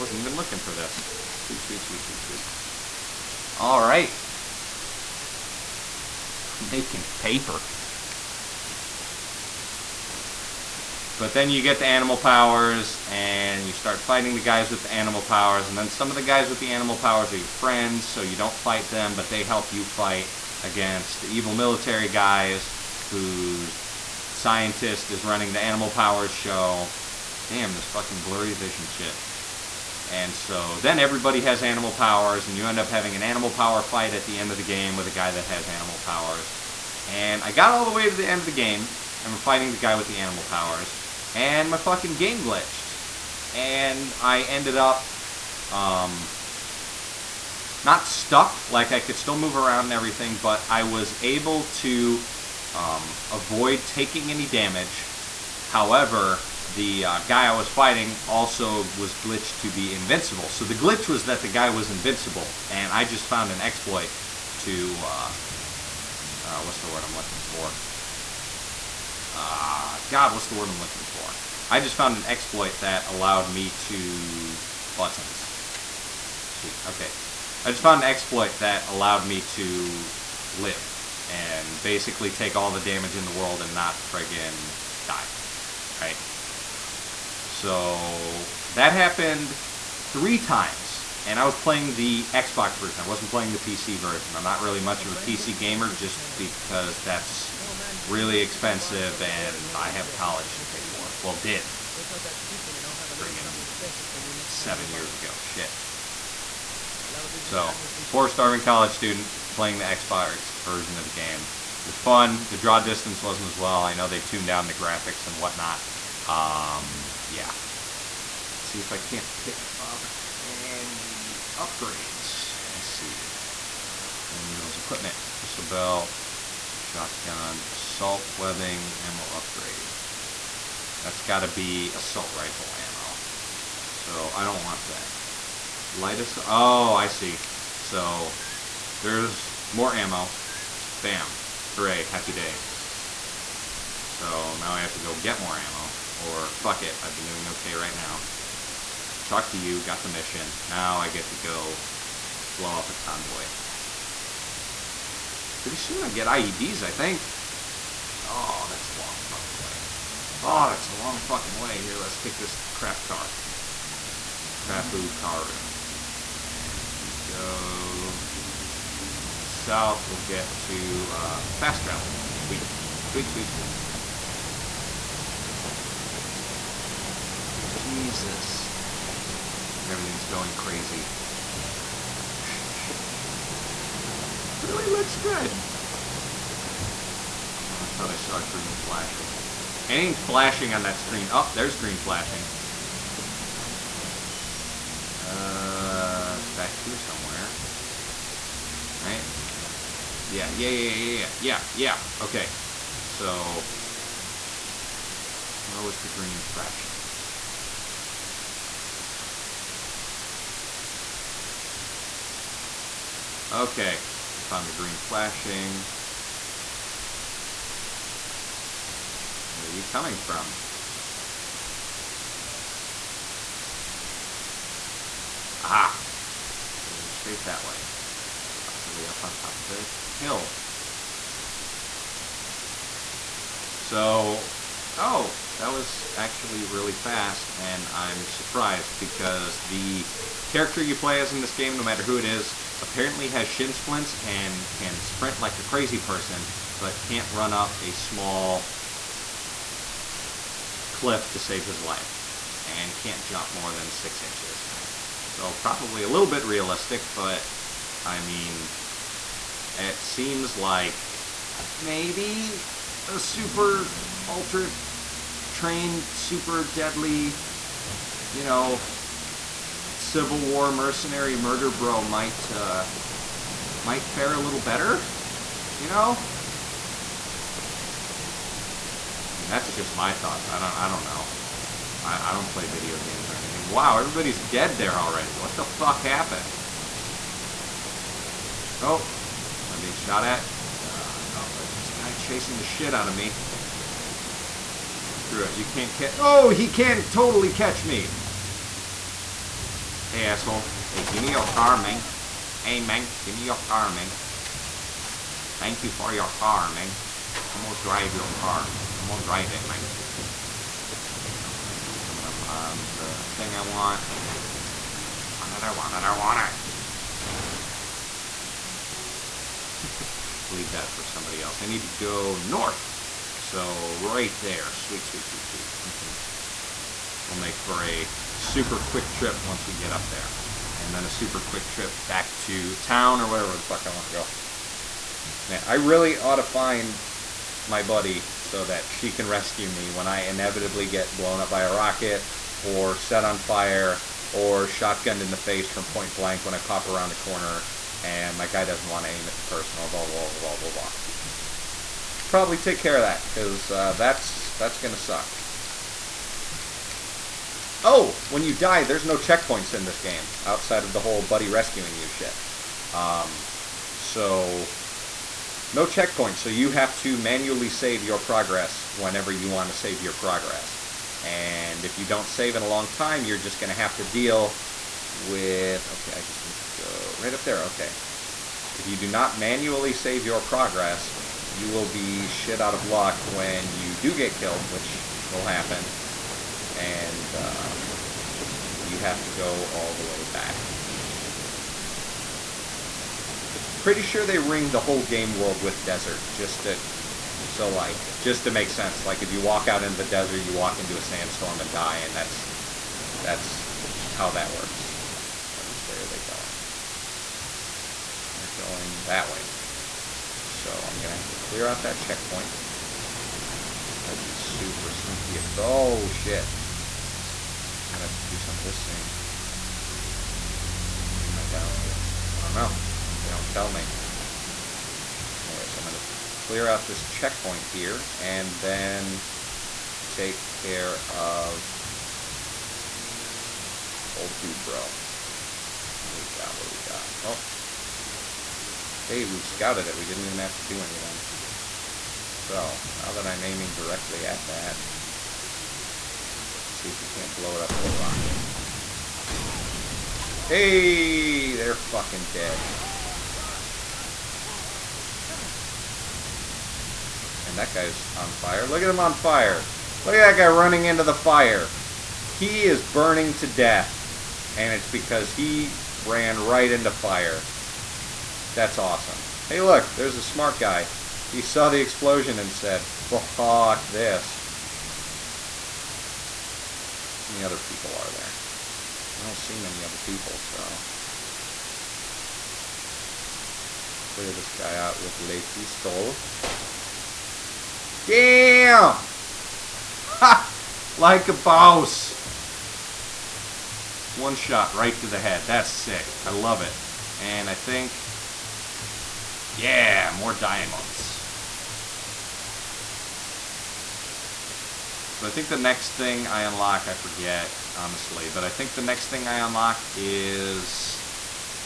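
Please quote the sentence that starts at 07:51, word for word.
He saw the explosion and said, fuck this many other people are there?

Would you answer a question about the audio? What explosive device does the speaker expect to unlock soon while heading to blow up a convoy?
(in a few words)
IEDs.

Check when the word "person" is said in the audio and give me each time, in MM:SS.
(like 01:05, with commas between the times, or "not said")
04:05, 05:49.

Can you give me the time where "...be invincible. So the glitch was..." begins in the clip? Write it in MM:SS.
00:59.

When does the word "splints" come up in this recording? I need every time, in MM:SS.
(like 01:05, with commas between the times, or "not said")
04:03.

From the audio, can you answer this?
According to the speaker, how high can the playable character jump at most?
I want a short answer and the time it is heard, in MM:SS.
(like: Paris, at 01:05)
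six inches, at 04:13.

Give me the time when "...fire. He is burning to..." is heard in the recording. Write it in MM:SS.
07:41.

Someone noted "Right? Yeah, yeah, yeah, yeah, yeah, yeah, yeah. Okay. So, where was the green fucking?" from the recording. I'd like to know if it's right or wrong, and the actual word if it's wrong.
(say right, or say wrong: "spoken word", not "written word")
wrong: "flashing", not "fucking".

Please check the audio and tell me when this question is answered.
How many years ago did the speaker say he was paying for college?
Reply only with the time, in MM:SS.
01:44.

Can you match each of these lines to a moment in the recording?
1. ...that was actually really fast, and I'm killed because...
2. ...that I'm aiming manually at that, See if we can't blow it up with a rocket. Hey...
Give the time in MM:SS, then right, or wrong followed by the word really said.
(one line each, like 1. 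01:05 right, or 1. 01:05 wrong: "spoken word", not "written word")
1. 03:55 wrong: "surprised", not "killed"
2. 07:23 wrong: "directly", not "manually".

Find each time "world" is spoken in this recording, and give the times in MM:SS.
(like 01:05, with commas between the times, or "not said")
01:23, 06:35.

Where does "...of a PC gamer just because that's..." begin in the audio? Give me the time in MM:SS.
01:35.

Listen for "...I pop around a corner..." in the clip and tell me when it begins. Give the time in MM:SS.
05:46.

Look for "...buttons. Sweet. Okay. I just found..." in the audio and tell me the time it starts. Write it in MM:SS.
01:14.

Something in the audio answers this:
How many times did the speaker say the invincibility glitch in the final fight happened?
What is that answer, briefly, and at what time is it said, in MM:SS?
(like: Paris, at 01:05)
3, at 01:30.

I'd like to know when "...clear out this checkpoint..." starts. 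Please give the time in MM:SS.
07:06.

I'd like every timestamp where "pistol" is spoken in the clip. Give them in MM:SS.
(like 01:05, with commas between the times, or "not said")
02:05, 08:05.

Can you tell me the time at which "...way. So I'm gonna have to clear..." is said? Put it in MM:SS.
06:49.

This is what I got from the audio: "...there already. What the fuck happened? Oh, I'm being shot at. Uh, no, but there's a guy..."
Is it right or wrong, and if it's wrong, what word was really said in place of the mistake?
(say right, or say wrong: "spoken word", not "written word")
right.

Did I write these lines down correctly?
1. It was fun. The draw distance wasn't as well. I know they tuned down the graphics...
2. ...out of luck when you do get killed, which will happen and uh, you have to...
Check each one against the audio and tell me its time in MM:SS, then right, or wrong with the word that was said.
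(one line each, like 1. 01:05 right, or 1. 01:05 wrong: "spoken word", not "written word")
1. 01:51 right
2. 06:22 right.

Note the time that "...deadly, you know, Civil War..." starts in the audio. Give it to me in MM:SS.
04:26.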